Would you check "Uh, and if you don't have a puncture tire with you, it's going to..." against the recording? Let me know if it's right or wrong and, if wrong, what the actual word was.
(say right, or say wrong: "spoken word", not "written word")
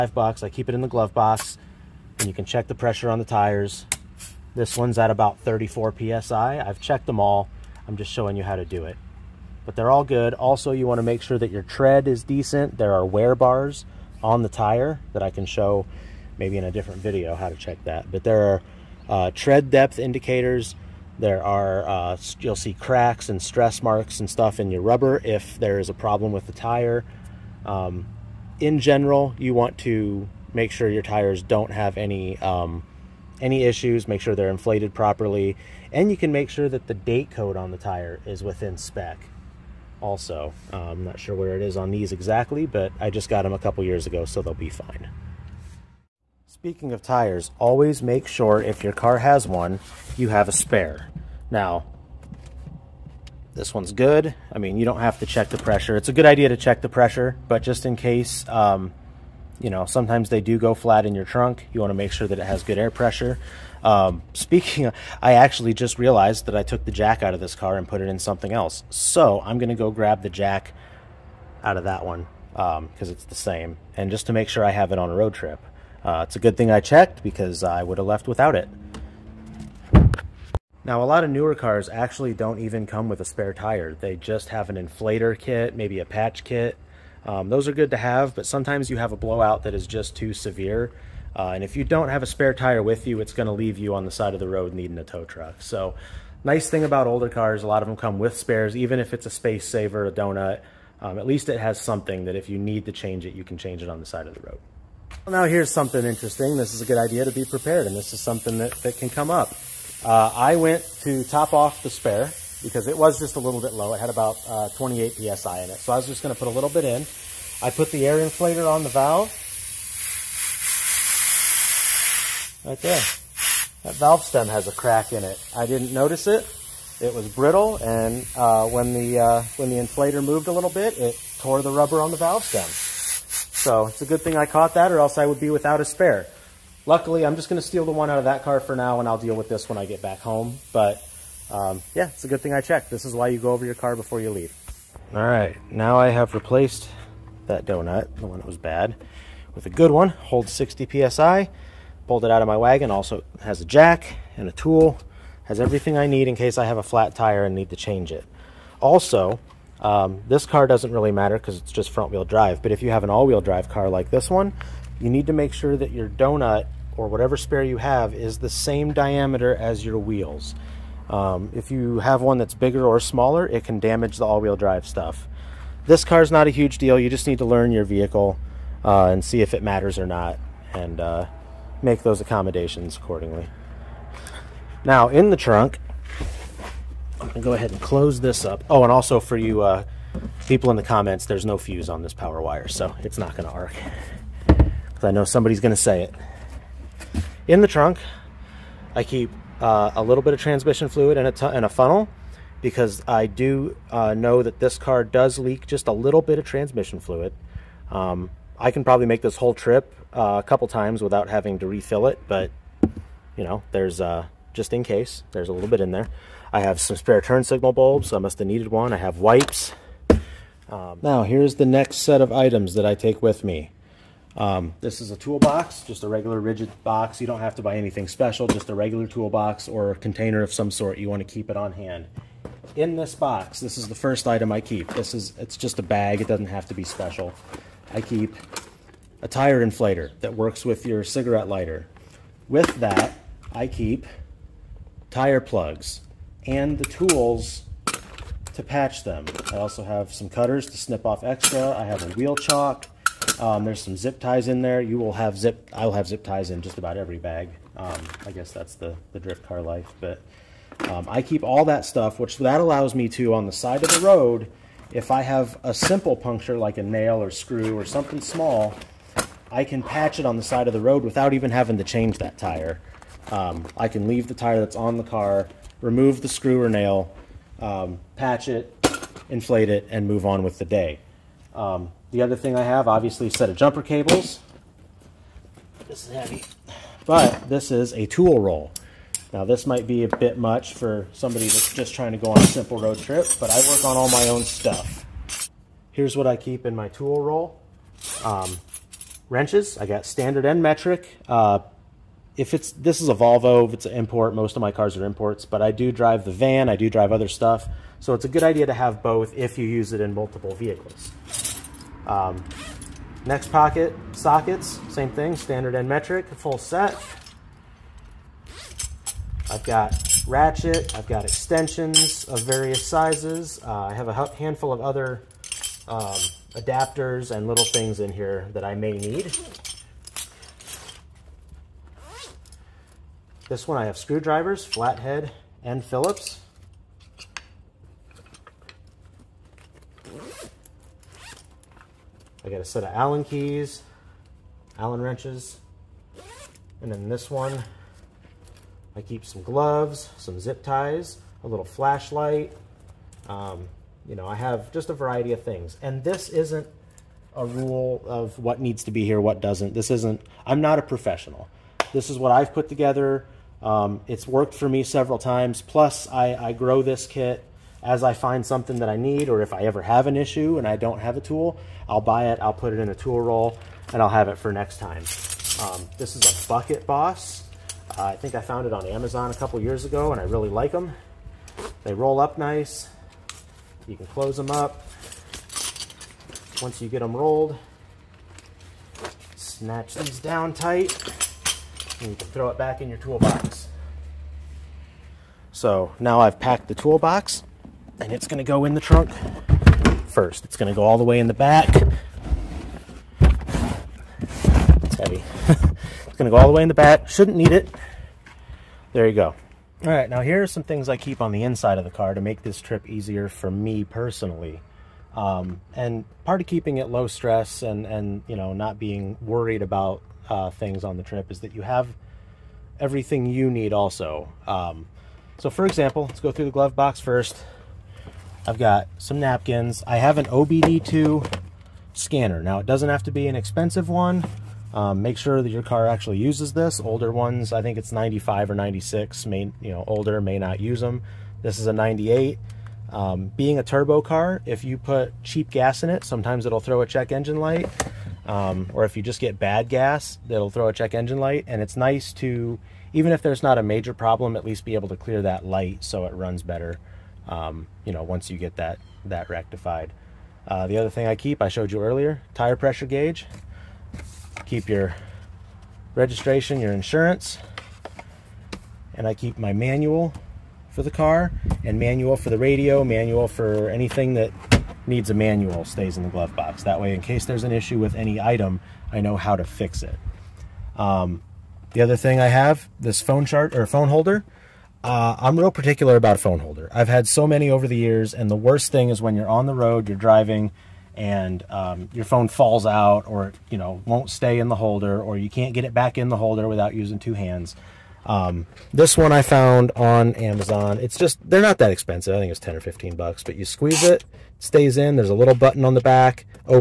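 wrong: "spare", not "puncture".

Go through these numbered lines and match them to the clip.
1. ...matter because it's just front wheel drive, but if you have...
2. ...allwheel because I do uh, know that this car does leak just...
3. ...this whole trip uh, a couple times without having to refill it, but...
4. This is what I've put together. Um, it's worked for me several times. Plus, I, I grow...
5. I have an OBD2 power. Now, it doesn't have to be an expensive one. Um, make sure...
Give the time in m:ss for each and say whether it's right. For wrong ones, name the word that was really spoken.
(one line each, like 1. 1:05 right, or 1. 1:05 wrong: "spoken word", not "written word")
1. 2:41 right
2. 3:21 wrong: "funnel", not "allwheel"
3. 3:29 right
4. 6:01 right
5. 7:09 wrong: "scanner", not "power".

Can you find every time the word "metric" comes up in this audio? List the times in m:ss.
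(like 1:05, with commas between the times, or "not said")
5:00, 5:15.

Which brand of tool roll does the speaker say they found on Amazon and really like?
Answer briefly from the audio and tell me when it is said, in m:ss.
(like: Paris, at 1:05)
Bucket Boss, at 6:16.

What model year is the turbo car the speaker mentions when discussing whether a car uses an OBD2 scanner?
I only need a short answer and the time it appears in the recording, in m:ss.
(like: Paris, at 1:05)
1998, at 7:21.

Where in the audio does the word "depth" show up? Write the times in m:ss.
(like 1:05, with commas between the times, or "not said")
0:19.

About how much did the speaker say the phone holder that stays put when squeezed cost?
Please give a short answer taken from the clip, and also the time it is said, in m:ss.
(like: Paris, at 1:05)
10 or 15 dollars, at 8:22.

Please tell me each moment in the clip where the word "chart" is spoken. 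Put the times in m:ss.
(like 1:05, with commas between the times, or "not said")
8:03.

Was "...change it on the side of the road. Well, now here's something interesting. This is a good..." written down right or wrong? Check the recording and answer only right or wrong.
right.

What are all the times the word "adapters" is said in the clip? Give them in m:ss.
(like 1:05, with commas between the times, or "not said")
5:26.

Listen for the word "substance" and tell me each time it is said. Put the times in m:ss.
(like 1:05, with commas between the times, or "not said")
not said.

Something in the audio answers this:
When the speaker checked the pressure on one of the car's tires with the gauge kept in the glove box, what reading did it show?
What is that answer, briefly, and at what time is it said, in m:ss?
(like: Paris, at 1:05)
34 PSI, at 0:05.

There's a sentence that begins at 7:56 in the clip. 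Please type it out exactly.
That way, in case there's an issue with any item, I know how to fix it.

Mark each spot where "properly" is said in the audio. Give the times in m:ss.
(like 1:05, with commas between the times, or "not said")
0:34.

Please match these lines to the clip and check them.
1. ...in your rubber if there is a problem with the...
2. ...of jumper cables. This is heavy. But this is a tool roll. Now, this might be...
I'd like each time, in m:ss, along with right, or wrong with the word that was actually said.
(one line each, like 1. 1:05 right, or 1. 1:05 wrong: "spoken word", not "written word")
1. 0:24 right
2. 4:43 right.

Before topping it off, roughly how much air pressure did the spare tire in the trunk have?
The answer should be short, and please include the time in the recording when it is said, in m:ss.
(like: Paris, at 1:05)
28 PSI, at 1:54.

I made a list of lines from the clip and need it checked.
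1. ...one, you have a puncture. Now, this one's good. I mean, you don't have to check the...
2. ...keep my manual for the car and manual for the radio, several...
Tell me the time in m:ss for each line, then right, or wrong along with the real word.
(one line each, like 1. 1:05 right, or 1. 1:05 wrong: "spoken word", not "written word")
1. 0:49 wrong: "spare", not "puncture"
2. 7:49 wrong: "manual", not "several".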